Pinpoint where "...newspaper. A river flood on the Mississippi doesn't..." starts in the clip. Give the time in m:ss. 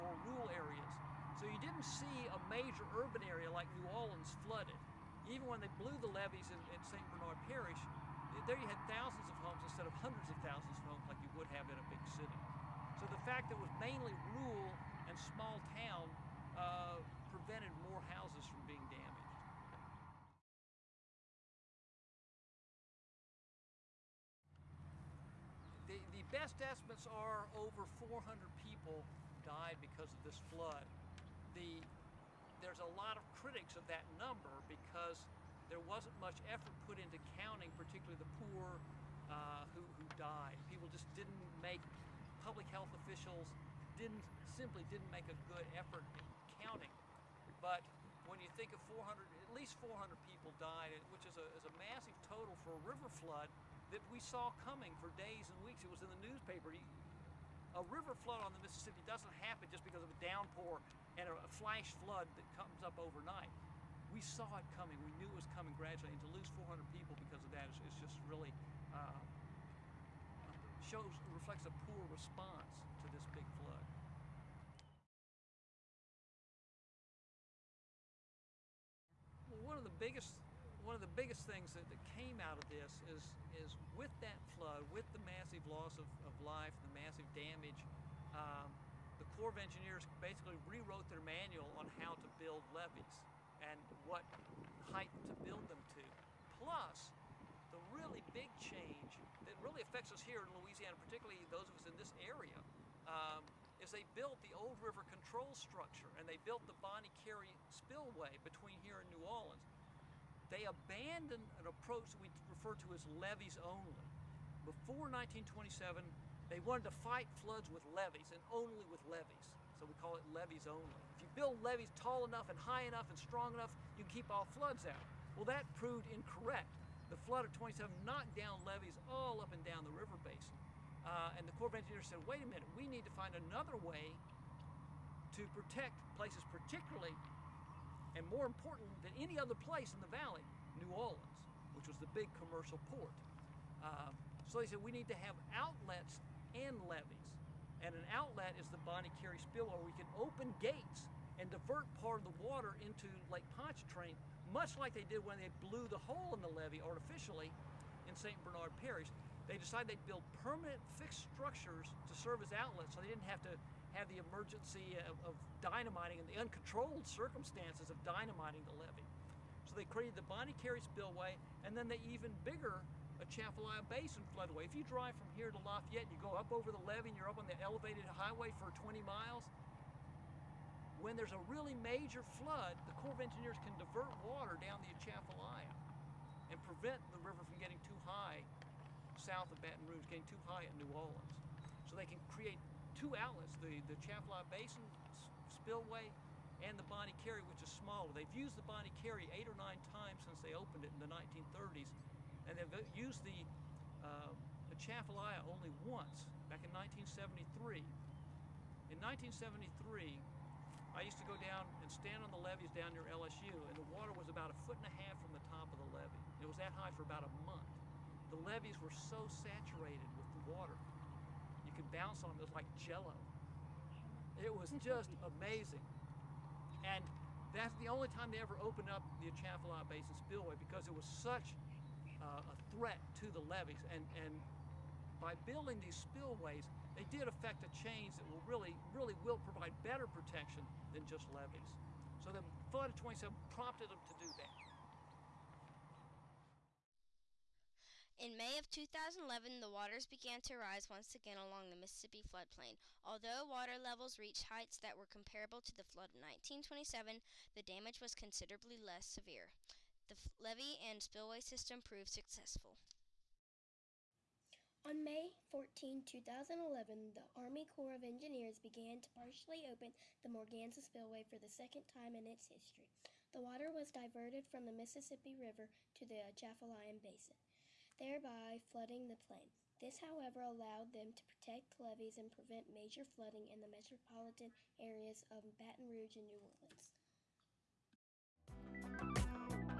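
0:56.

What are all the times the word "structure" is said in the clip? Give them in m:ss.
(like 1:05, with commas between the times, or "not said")
1:45, 2:41.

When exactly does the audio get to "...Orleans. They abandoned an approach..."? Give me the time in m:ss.
1:49.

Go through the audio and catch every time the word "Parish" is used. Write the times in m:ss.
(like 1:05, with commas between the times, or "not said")
0:07, 2:38.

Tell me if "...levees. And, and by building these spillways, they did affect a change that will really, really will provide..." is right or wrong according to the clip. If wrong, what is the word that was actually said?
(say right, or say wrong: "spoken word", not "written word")
right.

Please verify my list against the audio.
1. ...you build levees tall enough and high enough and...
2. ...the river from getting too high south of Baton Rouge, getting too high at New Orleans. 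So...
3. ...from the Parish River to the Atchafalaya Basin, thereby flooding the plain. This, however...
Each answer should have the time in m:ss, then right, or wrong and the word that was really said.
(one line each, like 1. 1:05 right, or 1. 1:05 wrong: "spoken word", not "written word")
1. 2:01 right
2. 3:07 right
3. 4:34 wrong: "Mississippi", not "Parish".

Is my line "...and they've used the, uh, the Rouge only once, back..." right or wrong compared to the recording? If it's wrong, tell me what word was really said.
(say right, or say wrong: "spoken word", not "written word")
wrong: "Chaffalaya", not "Rouge".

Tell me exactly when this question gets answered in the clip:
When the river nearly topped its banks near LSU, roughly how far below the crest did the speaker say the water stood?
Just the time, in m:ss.
3:34.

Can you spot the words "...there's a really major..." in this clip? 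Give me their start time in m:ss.
3:01.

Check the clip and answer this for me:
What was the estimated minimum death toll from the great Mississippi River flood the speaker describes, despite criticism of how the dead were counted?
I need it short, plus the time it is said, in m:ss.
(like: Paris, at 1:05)
400, at 0:27.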